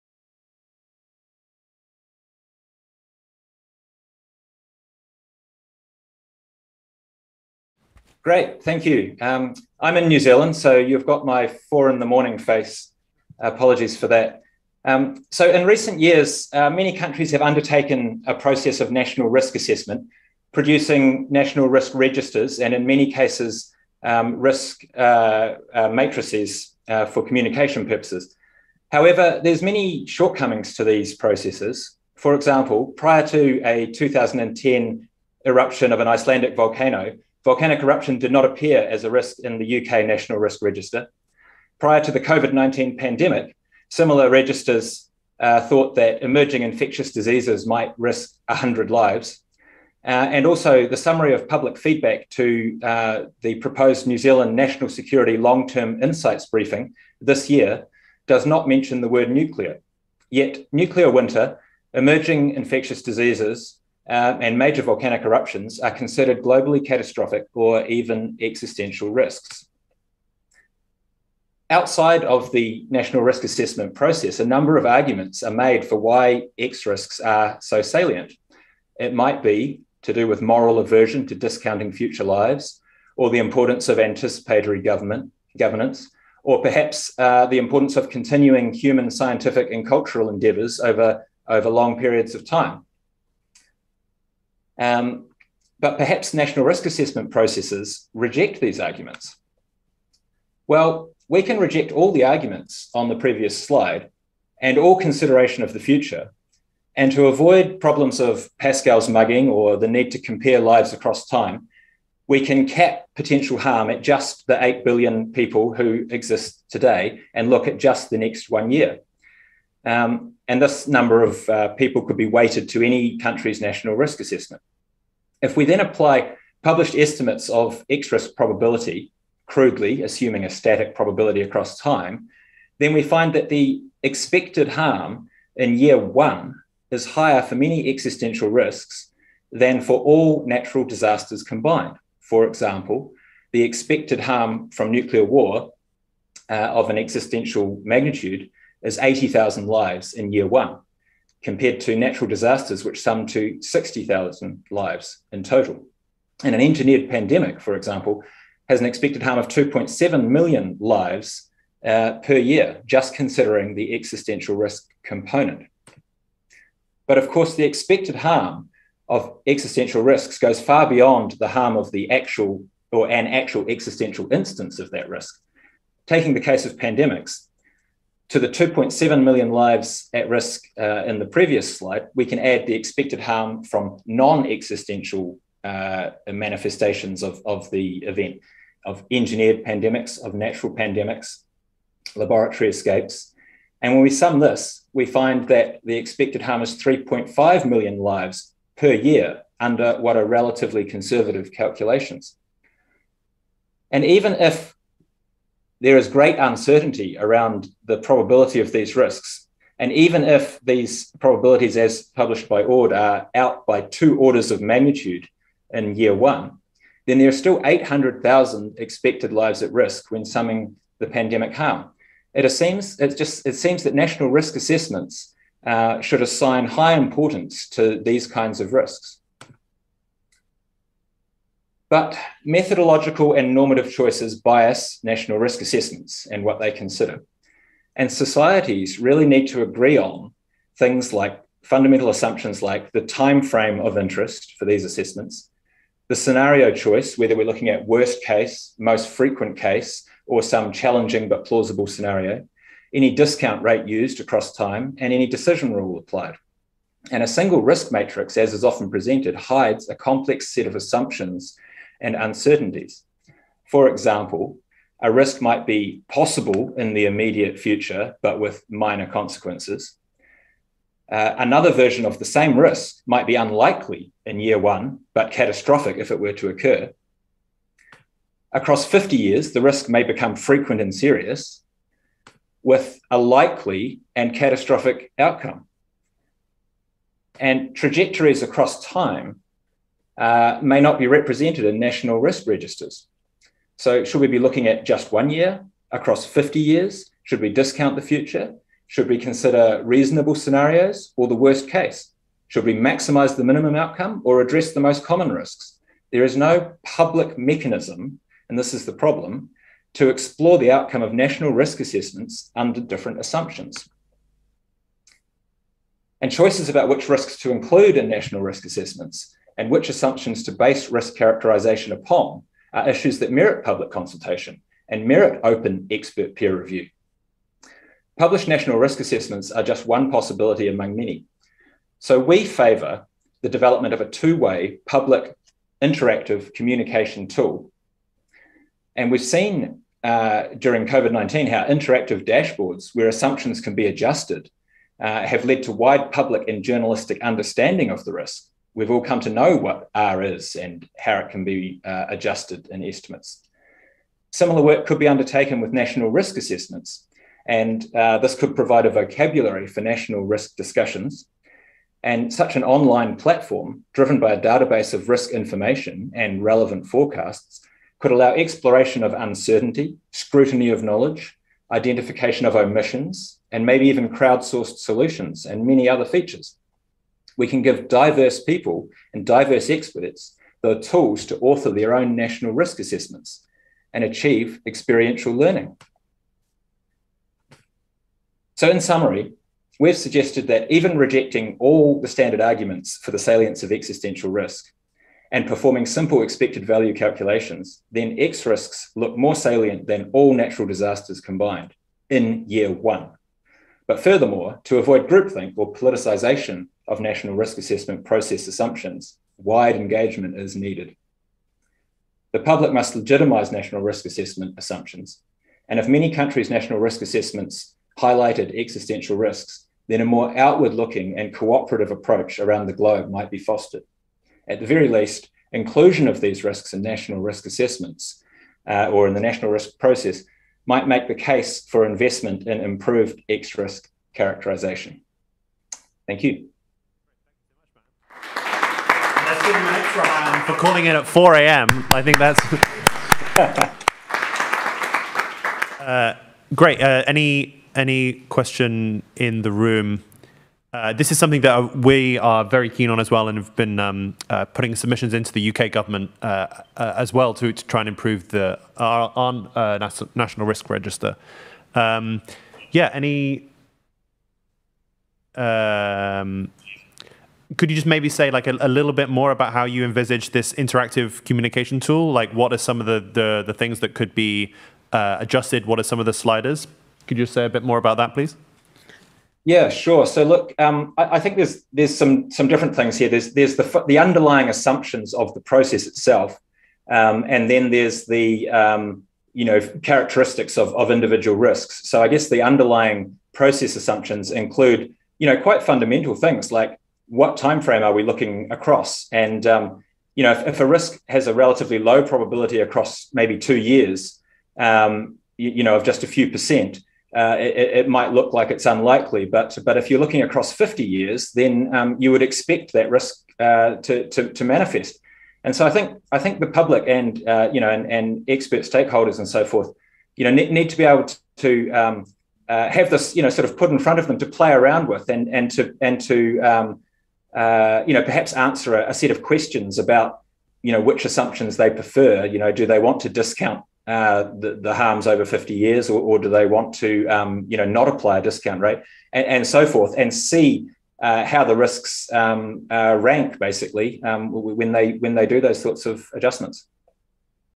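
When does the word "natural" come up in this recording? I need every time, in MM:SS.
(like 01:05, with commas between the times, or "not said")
02:20, 02:31, 03:10, 06:40.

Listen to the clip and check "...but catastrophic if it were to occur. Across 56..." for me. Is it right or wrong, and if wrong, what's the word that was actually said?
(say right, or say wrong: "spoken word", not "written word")
wrong: "50", not "56".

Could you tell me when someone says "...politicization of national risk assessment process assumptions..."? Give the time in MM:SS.
06:45.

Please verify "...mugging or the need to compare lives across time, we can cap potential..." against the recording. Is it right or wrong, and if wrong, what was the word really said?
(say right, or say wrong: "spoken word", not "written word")
right.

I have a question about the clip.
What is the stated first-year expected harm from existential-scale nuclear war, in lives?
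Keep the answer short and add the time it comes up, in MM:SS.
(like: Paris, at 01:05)
80,000, at 02:28.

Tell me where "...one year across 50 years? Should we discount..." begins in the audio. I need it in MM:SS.
04:55.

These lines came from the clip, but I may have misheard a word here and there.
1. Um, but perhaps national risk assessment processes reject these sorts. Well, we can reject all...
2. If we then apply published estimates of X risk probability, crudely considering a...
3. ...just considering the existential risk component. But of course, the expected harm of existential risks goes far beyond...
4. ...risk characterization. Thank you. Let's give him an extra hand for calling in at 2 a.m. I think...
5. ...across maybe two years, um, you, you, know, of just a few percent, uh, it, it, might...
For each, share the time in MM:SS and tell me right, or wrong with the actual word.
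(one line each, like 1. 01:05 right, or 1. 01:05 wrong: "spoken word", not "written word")
1. 01:34 wrong: "arguments", not "sorts"
2. 02:05 wrong: "assuming", not "considering"
3. 02:42 right
4. 07:13 wrong: "4", not "2"
5. 08:22 right.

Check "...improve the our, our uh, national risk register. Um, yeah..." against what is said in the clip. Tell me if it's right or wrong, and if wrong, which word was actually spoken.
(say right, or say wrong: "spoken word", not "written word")
right.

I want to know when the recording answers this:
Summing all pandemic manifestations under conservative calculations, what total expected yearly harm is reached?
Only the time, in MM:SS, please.
03:16.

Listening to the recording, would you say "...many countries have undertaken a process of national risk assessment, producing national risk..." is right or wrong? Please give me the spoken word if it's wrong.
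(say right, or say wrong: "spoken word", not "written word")
right.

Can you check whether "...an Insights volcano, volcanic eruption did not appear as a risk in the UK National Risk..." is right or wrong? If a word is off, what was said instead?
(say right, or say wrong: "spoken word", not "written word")
wrong: "Icelandic", not "Insights".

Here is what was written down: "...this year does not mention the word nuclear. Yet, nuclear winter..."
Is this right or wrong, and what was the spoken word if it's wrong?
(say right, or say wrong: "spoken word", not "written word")
right.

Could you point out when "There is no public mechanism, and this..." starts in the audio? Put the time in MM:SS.
05:06.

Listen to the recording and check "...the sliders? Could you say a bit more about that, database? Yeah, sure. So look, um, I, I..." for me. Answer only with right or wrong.
wrong.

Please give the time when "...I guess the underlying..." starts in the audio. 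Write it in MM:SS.
08:12.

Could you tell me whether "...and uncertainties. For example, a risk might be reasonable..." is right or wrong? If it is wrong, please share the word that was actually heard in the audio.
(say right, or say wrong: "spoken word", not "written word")
wrong: "possible", not "reasonable".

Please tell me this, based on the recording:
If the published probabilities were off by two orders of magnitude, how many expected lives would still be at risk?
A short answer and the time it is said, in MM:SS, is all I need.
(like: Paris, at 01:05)
800,000, at 03:37.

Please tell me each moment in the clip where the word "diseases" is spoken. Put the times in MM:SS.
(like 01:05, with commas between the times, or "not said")
00:47, 01:03.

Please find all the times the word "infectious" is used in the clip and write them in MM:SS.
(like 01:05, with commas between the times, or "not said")
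00:46, 01:02.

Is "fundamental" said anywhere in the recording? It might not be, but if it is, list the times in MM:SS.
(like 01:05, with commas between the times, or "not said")
04:01, 08:15.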